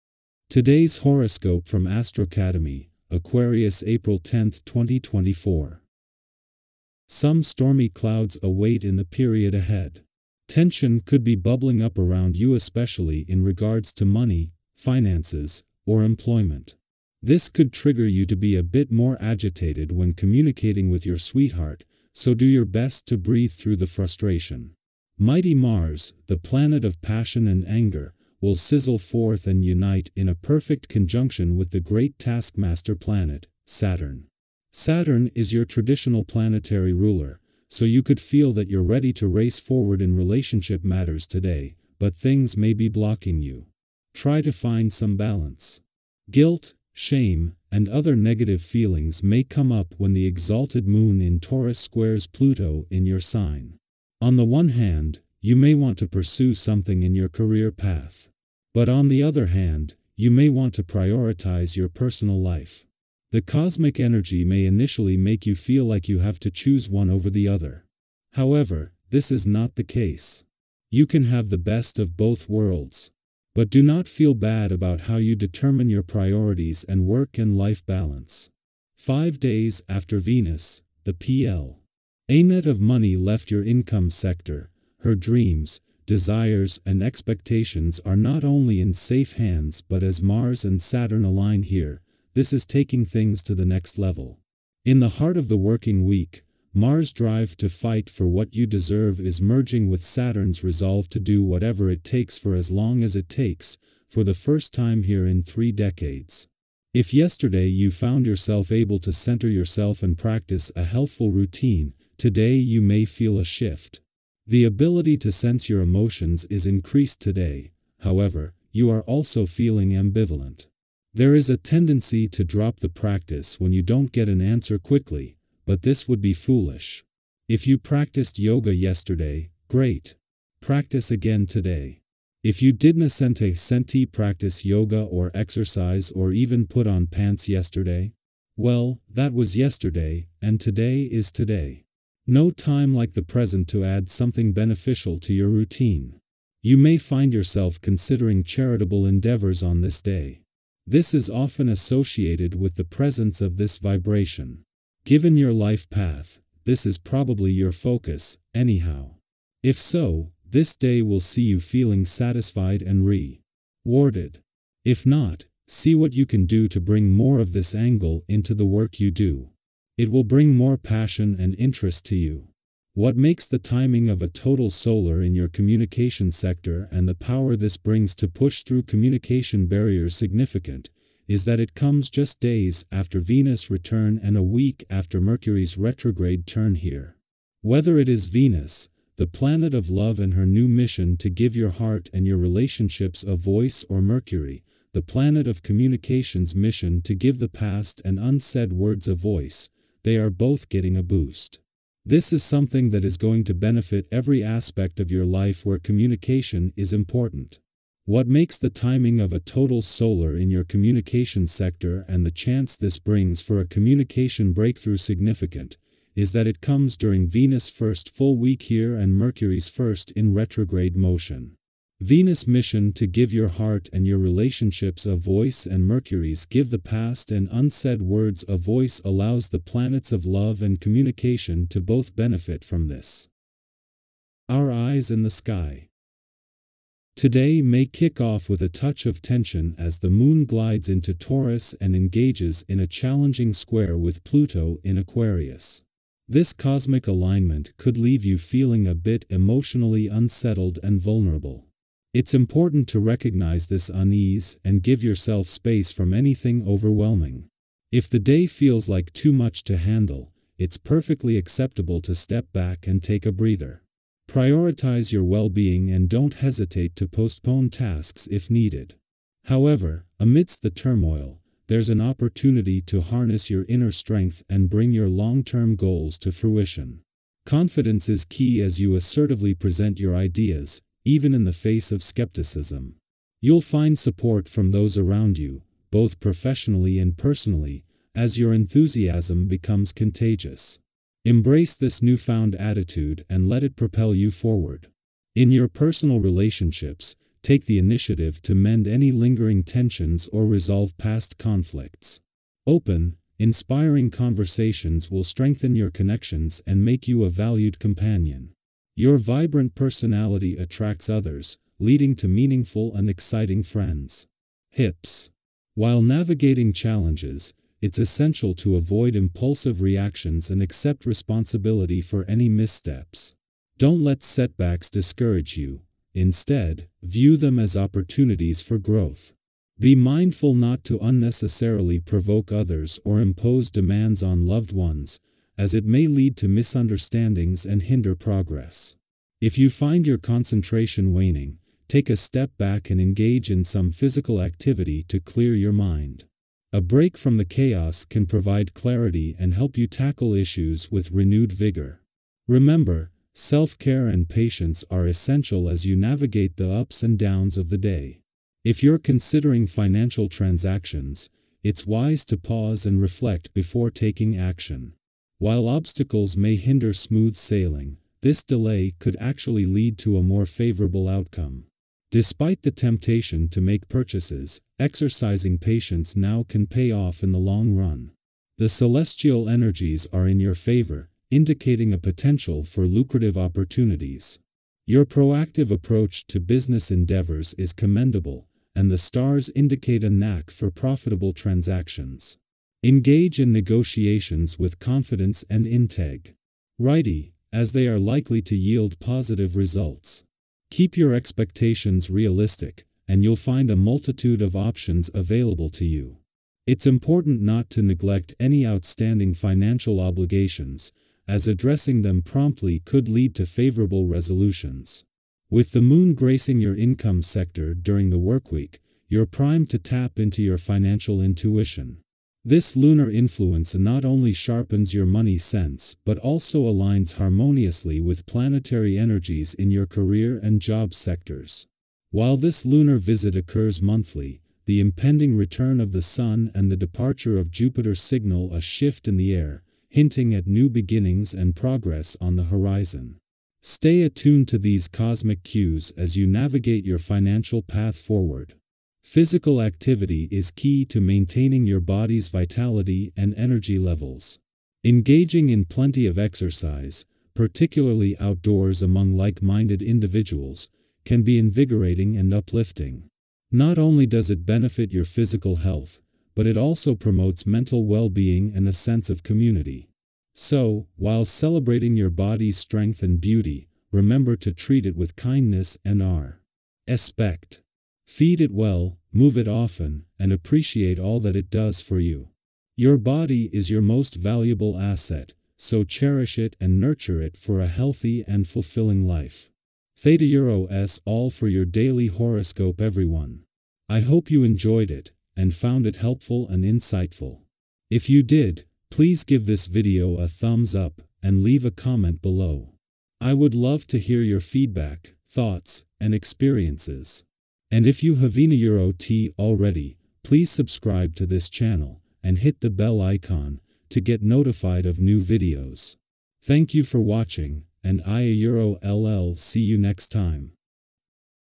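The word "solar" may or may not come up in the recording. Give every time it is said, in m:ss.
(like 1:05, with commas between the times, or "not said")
2:54, 3:29.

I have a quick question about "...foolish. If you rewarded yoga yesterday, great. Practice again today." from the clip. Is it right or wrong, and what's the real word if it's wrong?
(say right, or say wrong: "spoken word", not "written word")
wrong: "practiced", not "rewarded".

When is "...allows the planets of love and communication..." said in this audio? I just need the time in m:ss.
3:49.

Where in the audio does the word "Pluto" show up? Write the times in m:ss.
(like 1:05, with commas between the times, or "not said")
0:52, 4:04.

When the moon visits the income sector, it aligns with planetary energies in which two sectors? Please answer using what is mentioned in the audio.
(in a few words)
career and job.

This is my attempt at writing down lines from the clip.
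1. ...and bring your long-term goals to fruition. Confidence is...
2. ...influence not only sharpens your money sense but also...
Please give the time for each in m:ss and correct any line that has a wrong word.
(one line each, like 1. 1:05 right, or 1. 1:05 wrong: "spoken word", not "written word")
1. 4:34 right
2. 7:03 right.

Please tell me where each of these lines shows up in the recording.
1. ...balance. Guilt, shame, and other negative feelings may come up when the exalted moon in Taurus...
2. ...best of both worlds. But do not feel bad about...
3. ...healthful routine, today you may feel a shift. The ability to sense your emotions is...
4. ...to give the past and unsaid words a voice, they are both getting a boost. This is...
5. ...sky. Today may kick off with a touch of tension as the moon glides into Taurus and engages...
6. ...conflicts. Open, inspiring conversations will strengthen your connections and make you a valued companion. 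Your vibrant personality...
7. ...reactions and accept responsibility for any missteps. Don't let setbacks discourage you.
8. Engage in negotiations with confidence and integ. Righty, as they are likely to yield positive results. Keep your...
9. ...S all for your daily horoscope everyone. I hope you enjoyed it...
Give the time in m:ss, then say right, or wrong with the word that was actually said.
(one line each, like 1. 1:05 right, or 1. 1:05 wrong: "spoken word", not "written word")
1. 0:45 right
2. 1:11 right
3. 1:50 right
4. 3:17 right
5. 3:55 right
6. 5:01 right
7. 5:19 right
8. 6:32 right
9. 8:10 right.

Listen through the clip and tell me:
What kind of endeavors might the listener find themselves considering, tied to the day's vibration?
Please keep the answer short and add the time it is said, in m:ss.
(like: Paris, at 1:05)
charitable endeavors, at 2:28.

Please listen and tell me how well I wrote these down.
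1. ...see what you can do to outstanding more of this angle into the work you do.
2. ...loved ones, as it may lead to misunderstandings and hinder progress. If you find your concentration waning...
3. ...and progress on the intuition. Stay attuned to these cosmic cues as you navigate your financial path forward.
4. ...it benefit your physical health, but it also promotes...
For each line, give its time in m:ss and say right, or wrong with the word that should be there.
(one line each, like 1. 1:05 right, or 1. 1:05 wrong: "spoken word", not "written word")
1. 2:45 wrong: "bring", not "outstanding"
2. 5:34 right
3. 7:21 wrong: "horizon", not "intuition"
4. 7:44 right.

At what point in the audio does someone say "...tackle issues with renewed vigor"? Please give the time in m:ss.
5:49.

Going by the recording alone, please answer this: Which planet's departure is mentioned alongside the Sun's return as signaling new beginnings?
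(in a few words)
Jupiter.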